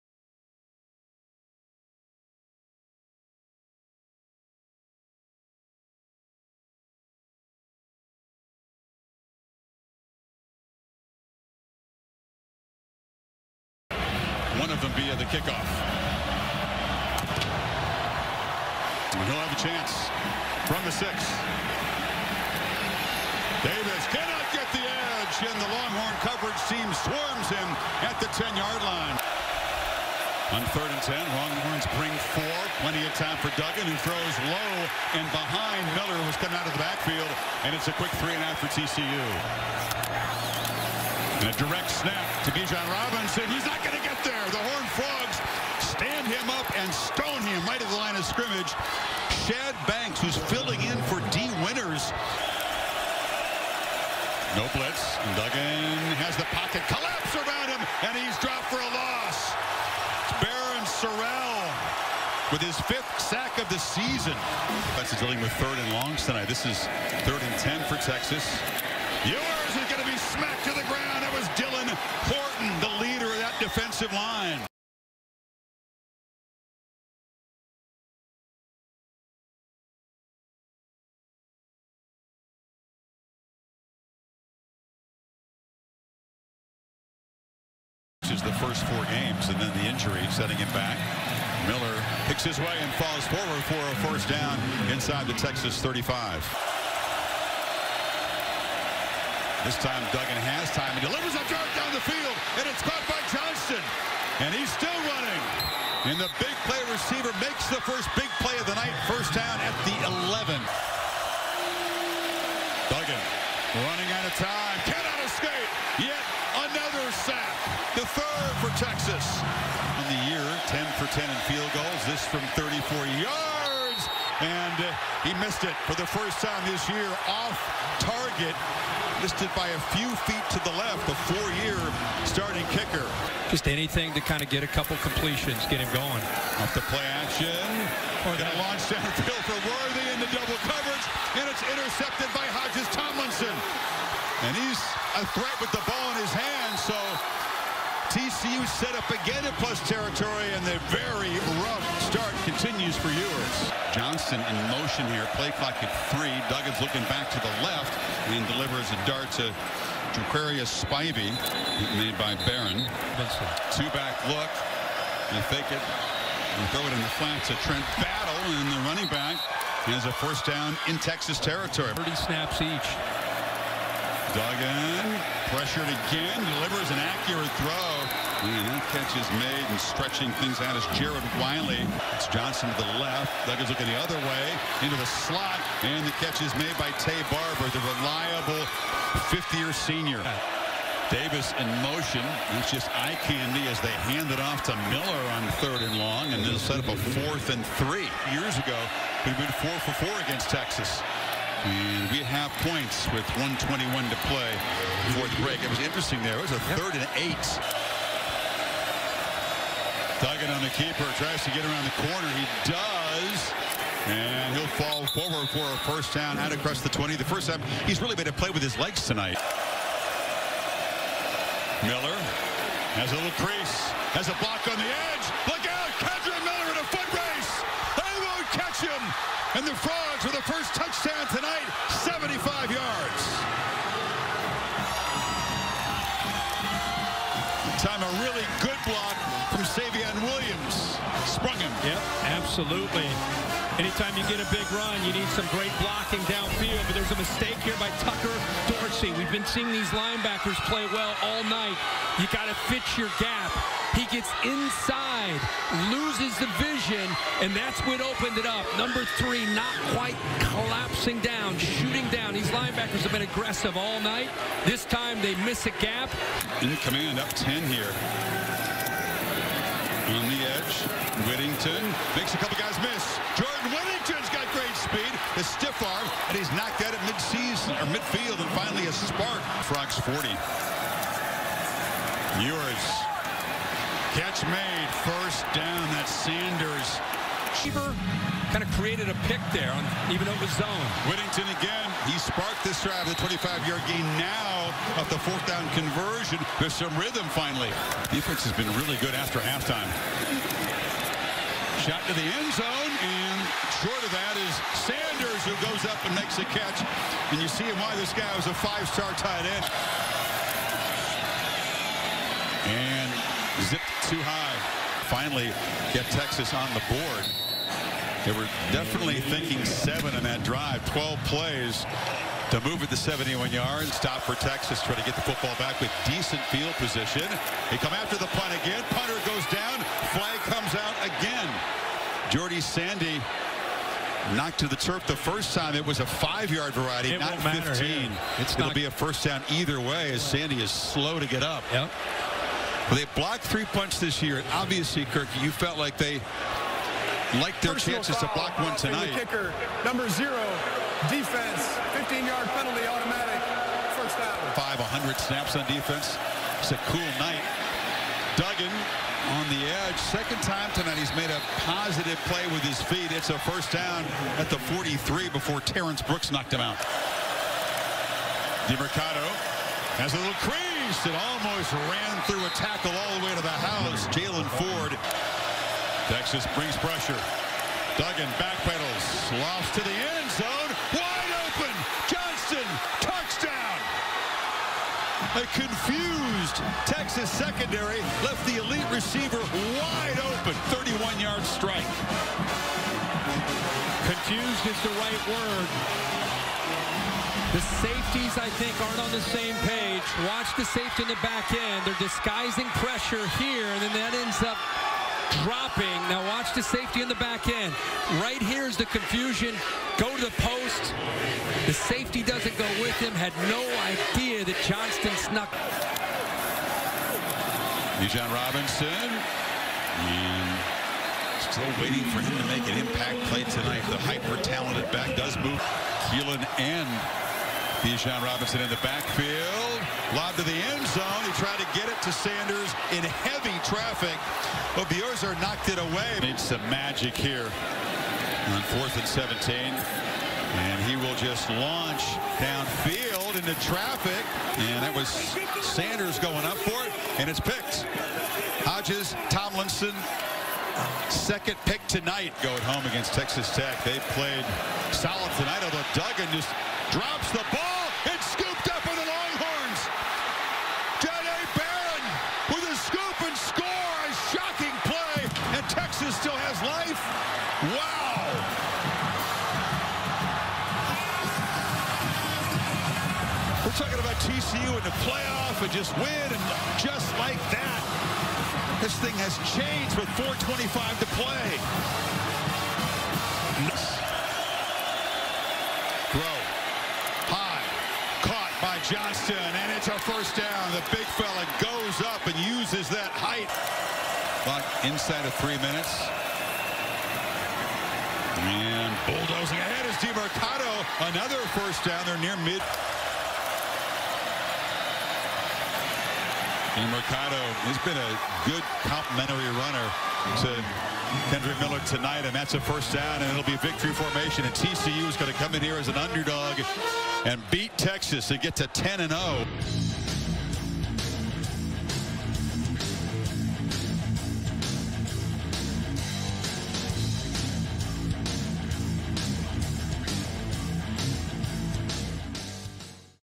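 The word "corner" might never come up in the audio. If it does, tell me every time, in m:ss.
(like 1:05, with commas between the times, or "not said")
3:31.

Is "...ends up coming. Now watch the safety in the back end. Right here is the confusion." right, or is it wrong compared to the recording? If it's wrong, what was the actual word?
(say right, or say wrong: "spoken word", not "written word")
wrong: "dropping", not "coming".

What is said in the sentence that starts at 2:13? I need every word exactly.
Just anything to kind of get a couple completions, get him going.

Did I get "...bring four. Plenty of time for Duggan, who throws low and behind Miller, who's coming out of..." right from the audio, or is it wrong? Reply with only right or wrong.
right.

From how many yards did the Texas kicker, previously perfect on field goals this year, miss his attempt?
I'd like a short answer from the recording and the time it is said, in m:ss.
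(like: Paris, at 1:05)
34, at 2:02.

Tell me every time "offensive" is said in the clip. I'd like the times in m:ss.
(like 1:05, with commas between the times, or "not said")
1:14.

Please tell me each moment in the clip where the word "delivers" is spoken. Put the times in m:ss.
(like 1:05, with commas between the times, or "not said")
1:41, 2:38, 2:56.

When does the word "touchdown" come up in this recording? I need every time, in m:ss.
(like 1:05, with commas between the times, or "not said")
3:50, 6:22.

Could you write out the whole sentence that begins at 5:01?
Shot to the end zone, and short of that is Sanders who goes up and makes a catch.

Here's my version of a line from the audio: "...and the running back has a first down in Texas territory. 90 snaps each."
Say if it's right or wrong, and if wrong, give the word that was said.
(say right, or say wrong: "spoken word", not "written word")
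wrong: "30", not "90".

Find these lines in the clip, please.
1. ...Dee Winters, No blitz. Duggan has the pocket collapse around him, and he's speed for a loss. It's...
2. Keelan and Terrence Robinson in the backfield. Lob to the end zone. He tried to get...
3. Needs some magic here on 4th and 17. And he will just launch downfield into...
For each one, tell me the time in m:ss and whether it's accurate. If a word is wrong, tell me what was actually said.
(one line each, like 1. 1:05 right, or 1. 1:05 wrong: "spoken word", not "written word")
1. 0:51 wrong: "dropped", not "speed"
2. 7:06 wrong: "Bijan", not "Terrence"
3. 7:16 right.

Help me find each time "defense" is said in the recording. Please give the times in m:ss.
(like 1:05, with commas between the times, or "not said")
4:58, 5:51, 5:55.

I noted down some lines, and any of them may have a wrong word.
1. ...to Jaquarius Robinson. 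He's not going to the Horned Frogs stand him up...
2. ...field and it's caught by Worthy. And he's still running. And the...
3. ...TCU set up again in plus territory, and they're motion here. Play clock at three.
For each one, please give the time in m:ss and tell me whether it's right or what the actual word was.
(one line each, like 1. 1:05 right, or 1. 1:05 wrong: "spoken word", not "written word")
1. 0:42 wrong: "Bijan", not "Jaquarius"
2. 1:41 wrong: "Wilson", not "Worthy"
3. 2:28 right.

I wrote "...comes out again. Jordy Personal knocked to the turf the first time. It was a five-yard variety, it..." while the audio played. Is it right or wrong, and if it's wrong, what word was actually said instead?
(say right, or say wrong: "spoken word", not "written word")
wrong: "Sandy", not "Personal".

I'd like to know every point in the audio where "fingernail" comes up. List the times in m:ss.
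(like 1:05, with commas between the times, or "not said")
not said.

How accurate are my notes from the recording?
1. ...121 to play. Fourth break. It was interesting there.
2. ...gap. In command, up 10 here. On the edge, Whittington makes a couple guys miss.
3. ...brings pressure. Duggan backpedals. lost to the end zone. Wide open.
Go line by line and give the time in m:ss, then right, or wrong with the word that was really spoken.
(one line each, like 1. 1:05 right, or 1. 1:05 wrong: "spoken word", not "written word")
1. 3:23 right
2. 4:25 right
3. 6:16 right.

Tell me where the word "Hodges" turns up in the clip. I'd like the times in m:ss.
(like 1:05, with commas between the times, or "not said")
2:22, 7:28.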